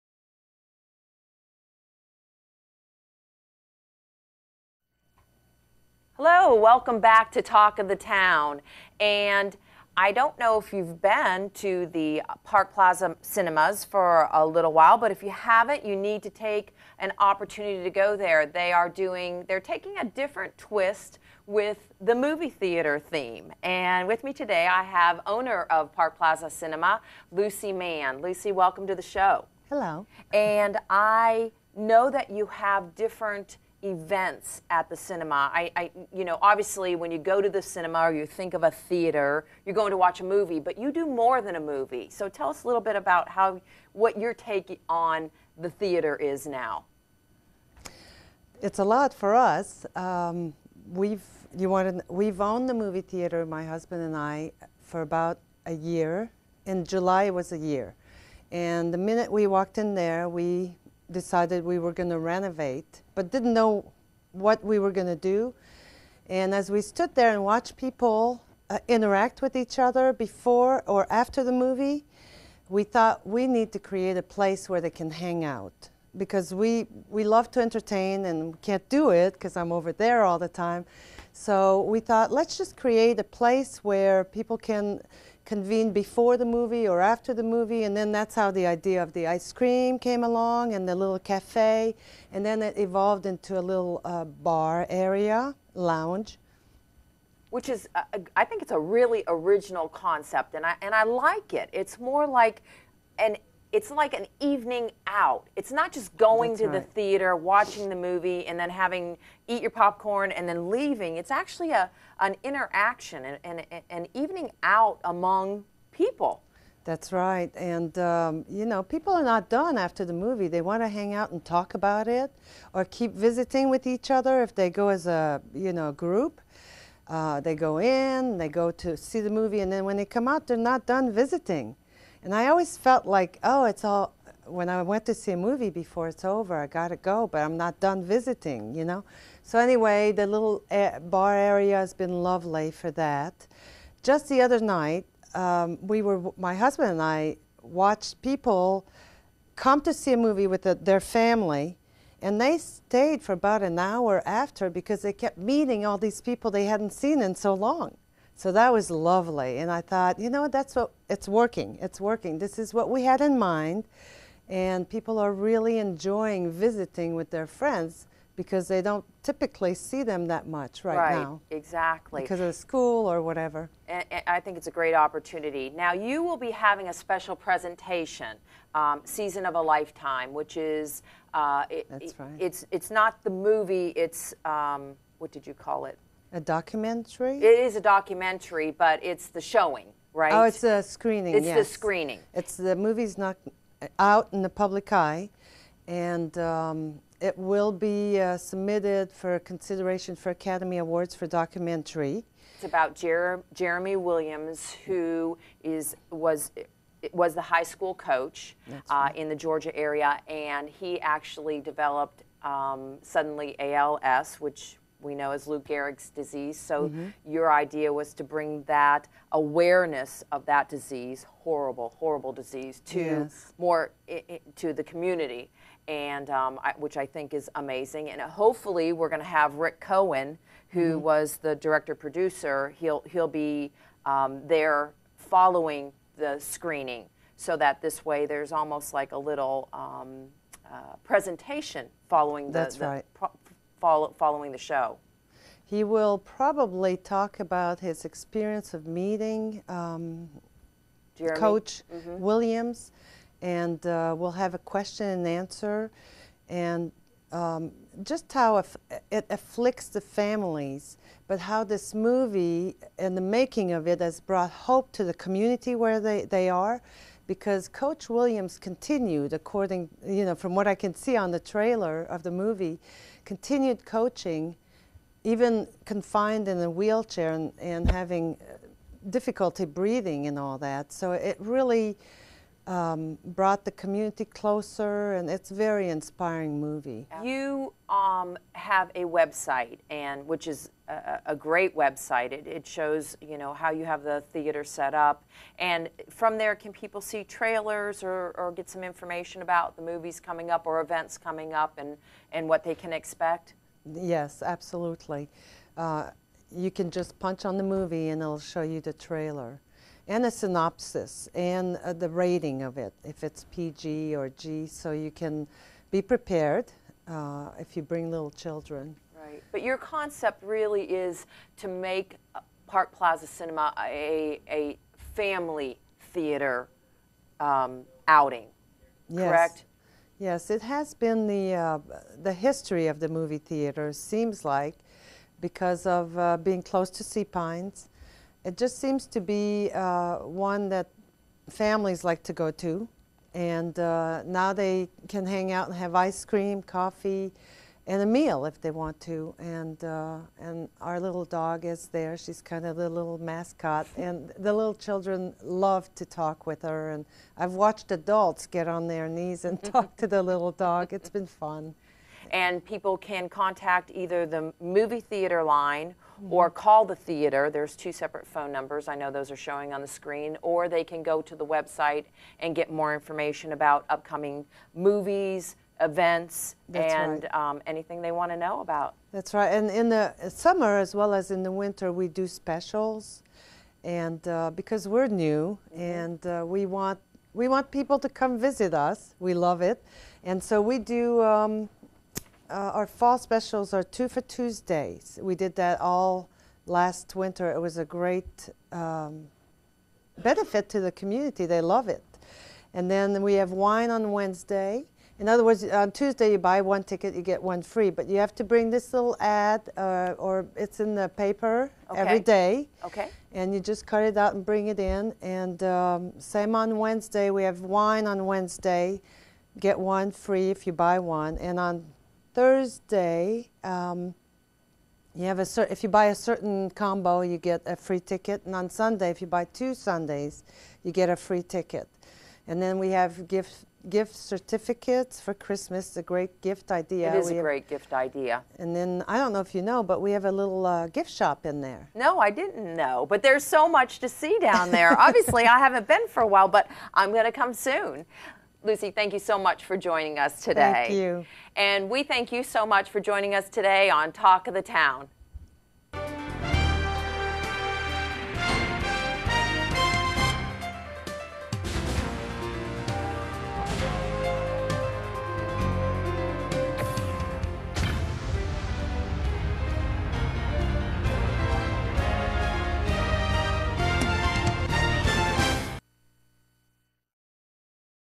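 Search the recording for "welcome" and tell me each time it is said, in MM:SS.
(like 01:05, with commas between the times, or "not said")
00:06, 00:28.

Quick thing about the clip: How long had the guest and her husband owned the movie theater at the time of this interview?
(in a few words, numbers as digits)
About a year.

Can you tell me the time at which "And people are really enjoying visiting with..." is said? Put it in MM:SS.
02:44.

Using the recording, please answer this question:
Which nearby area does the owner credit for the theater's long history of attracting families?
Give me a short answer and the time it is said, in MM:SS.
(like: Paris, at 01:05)
Sea Pines, at 05:37.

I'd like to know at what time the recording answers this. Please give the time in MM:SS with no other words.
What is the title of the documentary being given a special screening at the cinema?
02:59.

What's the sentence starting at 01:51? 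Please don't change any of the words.
It's actually a an interaction and an, an evening out among people.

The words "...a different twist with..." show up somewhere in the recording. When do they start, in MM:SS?
00:19.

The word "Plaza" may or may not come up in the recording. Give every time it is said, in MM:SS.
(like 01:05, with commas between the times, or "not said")
00:12, 00:26, 05:22.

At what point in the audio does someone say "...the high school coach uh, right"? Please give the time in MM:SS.
03:27.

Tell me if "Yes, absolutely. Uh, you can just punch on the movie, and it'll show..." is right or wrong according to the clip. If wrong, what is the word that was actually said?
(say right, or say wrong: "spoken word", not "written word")
right.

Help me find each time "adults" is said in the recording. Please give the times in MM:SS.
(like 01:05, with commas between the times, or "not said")
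05:57.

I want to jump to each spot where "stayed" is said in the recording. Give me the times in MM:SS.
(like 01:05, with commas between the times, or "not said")
02:32.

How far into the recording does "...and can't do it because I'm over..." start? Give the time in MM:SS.
01:18.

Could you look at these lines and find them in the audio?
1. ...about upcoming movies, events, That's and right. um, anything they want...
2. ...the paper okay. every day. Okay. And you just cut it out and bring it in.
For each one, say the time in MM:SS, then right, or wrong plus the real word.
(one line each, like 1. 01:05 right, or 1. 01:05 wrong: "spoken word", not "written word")
1. 06:13 right
2. 06:50 right.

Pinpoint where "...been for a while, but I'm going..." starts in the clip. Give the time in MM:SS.
07:25.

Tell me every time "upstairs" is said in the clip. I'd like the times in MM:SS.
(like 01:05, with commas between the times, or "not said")
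not said.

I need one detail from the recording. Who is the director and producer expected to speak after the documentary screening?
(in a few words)
Rick Cohen.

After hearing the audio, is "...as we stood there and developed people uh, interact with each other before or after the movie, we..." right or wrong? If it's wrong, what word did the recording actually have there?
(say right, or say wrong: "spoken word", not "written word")
wrong: "watched", not "developed".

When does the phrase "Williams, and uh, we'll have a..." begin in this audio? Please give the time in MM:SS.
04:12.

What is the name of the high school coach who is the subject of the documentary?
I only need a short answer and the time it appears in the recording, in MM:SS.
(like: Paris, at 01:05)
Jeremy Williams, at 03:23.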